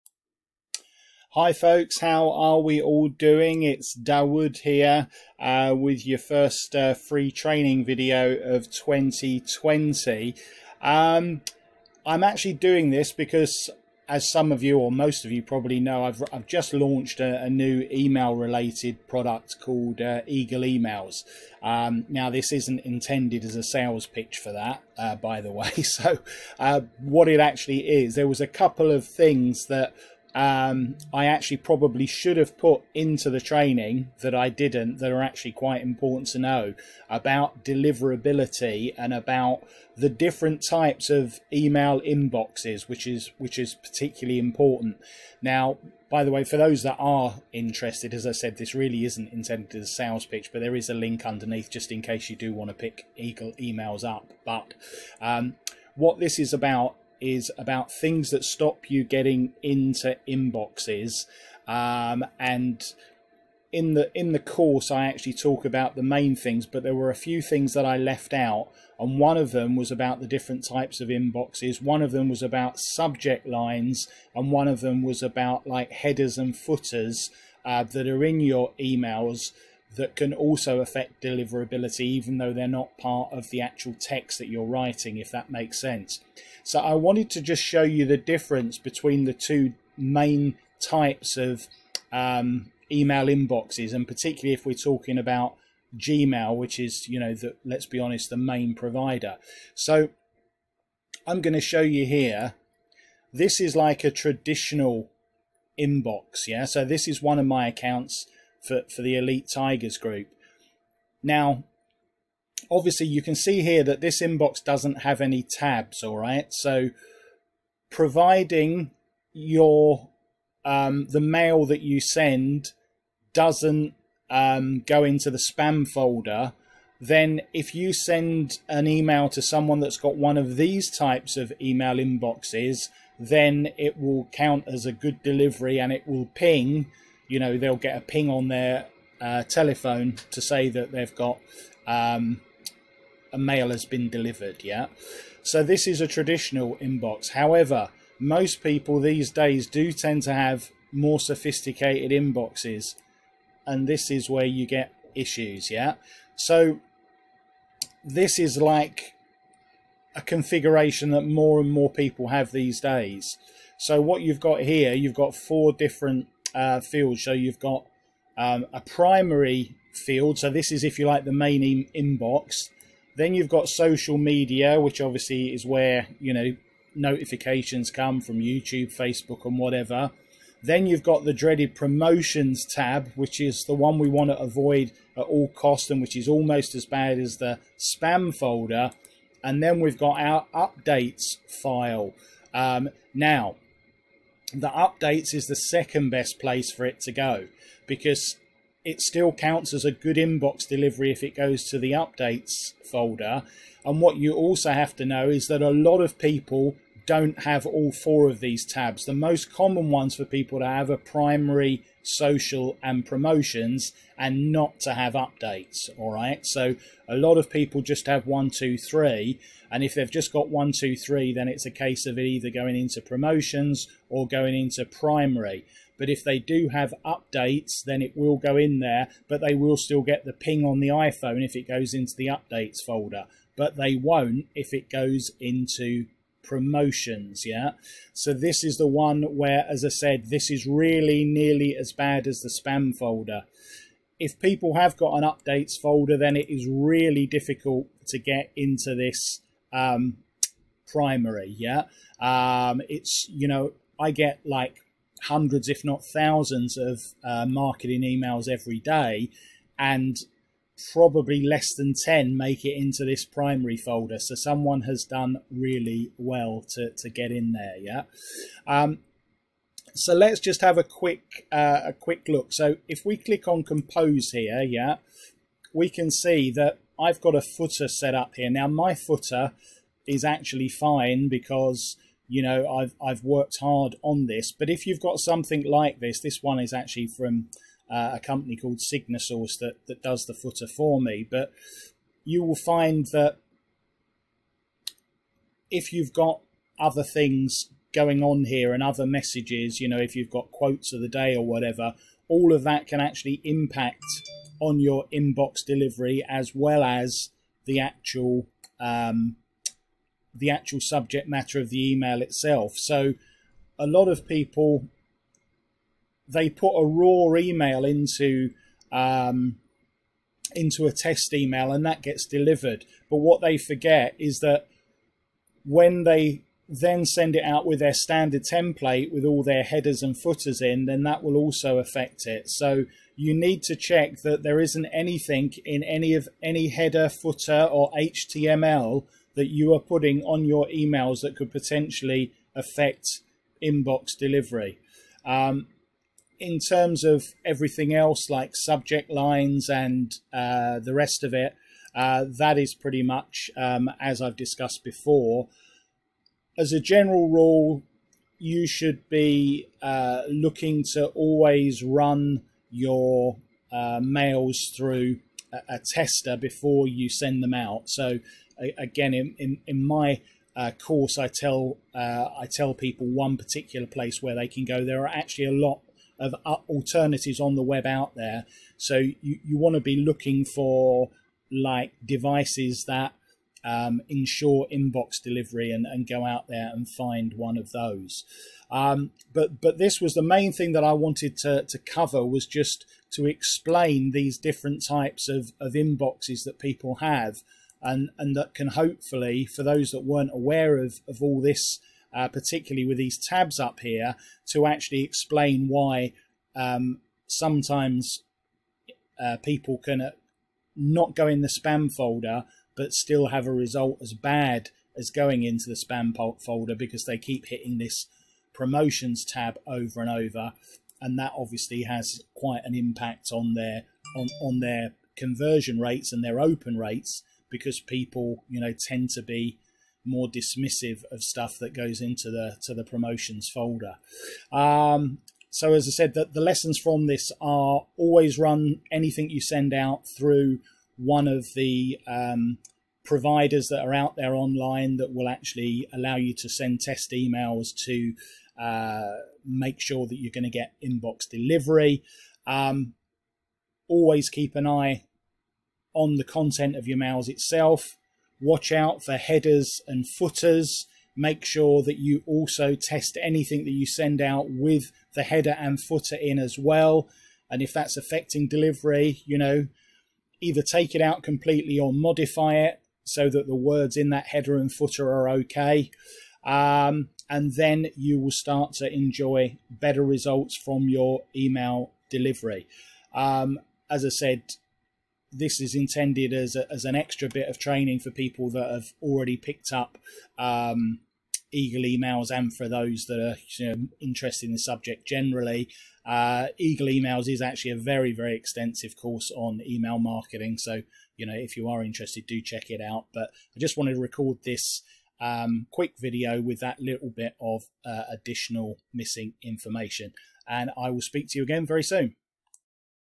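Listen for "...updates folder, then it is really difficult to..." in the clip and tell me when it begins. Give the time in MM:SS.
04:05.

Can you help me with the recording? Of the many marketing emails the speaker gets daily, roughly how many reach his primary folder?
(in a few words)
less than 10.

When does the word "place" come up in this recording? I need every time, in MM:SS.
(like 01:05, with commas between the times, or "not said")
03:16, 06:13.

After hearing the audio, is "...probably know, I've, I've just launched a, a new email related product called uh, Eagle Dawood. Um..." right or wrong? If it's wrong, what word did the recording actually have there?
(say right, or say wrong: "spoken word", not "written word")
wrong: "Emails", not "Dawood".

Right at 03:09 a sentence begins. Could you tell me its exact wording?
And then we've got our updates file.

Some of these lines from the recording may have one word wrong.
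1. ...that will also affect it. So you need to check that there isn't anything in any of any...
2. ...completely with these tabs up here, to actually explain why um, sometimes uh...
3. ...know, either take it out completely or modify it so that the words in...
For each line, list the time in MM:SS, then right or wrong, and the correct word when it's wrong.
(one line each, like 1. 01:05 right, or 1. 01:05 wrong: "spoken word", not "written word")
1. 05:31 right
2. 06:42 wrong: "particularly", not "completely"
3. 07:49 right.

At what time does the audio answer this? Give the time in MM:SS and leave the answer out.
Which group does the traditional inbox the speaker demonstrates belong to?
01:49.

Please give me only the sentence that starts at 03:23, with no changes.
And what you also have to know is that a lot of people don't have all four of these tabs.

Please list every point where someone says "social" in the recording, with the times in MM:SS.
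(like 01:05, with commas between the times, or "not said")
02:53, 03:32.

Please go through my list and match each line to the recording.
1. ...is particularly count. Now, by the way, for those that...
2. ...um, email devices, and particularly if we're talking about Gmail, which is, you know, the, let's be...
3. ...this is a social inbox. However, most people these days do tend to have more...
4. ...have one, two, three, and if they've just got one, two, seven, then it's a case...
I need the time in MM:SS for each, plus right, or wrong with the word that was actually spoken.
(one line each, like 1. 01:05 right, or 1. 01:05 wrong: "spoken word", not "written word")
1. 00:43 wrong: "important", not "count"
2. 01:32 wrong: "inboxes", not "devices"
3. 02:25 wrong: "traditional", not "social"
4. 03:38 wrong: "three", not "seven".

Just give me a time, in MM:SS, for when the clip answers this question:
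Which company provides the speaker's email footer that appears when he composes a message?
04:48.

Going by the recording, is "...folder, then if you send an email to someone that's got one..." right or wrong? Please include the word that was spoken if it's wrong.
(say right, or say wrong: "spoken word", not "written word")
right.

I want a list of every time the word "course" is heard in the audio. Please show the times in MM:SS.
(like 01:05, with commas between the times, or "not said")
01:04, 06:10, 08:18.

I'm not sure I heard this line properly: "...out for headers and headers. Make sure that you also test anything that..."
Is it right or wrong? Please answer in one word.
wrong.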